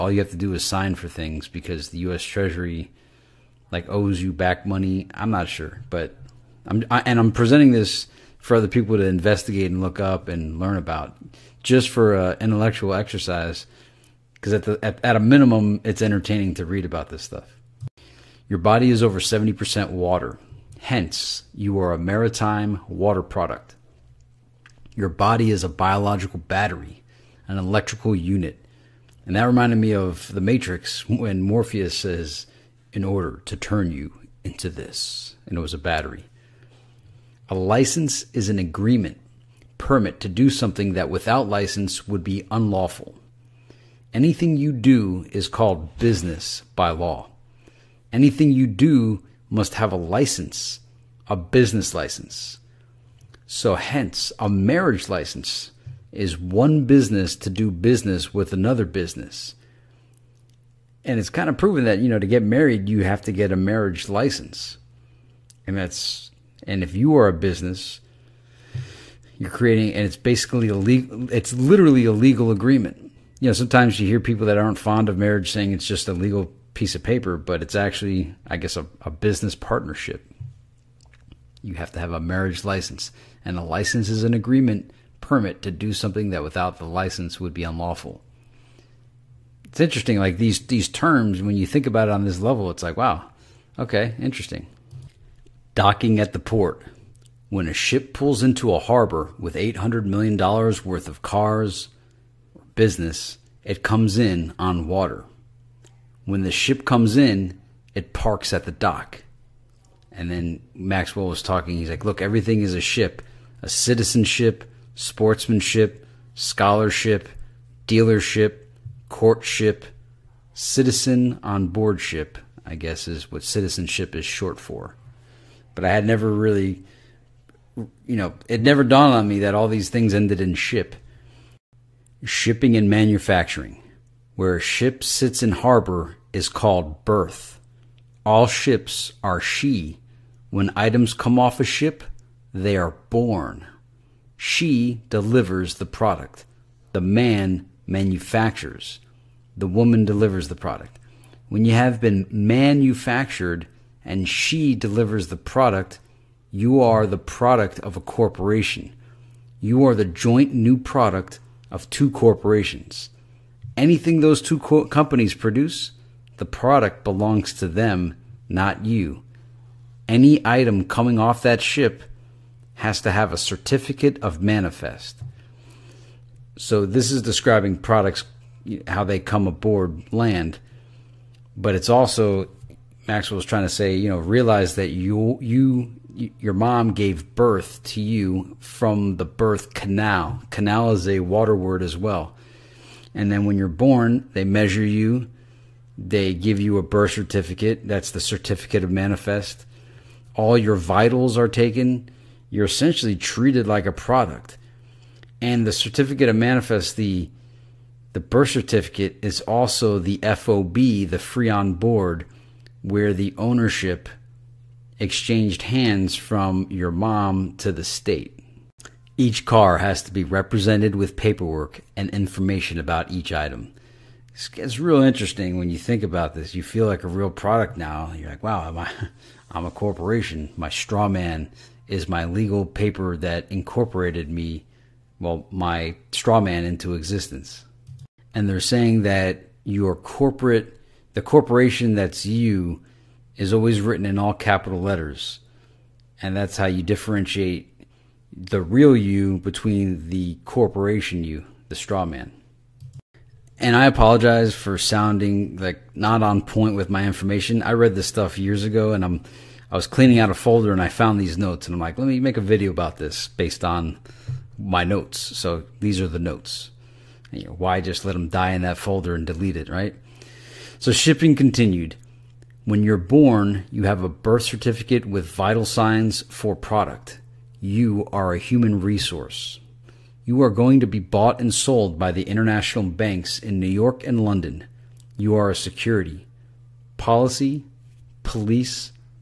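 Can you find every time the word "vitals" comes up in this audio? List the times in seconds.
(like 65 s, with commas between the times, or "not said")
200 s, 275 s.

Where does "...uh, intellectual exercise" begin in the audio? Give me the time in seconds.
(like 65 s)
12 s.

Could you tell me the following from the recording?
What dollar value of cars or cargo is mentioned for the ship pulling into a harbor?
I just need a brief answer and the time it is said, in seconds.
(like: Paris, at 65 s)
$800 million, at 99 s.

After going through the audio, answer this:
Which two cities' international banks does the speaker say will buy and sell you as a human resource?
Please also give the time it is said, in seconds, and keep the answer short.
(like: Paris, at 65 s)
New York and London, at 283 s.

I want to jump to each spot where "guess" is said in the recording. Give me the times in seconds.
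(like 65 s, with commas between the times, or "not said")
78 s, 122 s.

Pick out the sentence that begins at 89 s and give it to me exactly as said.
It's interesting, like these these terms.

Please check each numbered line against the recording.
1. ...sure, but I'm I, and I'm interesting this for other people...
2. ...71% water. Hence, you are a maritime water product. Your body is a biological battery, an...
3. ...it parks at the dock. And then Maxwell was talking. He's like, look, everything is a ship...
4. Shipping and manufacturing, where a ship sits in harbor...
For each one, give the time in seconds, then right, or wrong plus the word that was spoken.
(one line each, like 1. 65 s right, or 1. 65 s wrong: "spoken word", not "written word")
1. 5 s wrong: "presenting", not "interesting"
2. 19 s wrong: "70", not "71"
3. 107 s right
4. 132 s right.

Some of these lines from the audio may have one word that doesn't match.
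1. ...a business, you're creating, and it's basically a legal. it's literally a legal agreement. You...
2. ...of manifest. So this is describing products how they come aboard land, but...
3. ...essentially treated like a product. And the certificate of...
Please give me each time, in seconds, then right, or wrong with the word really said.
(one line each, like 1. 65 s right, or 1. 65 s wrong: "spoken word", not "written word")
1. 67 s right
2. 174 s right
3. 202 s right.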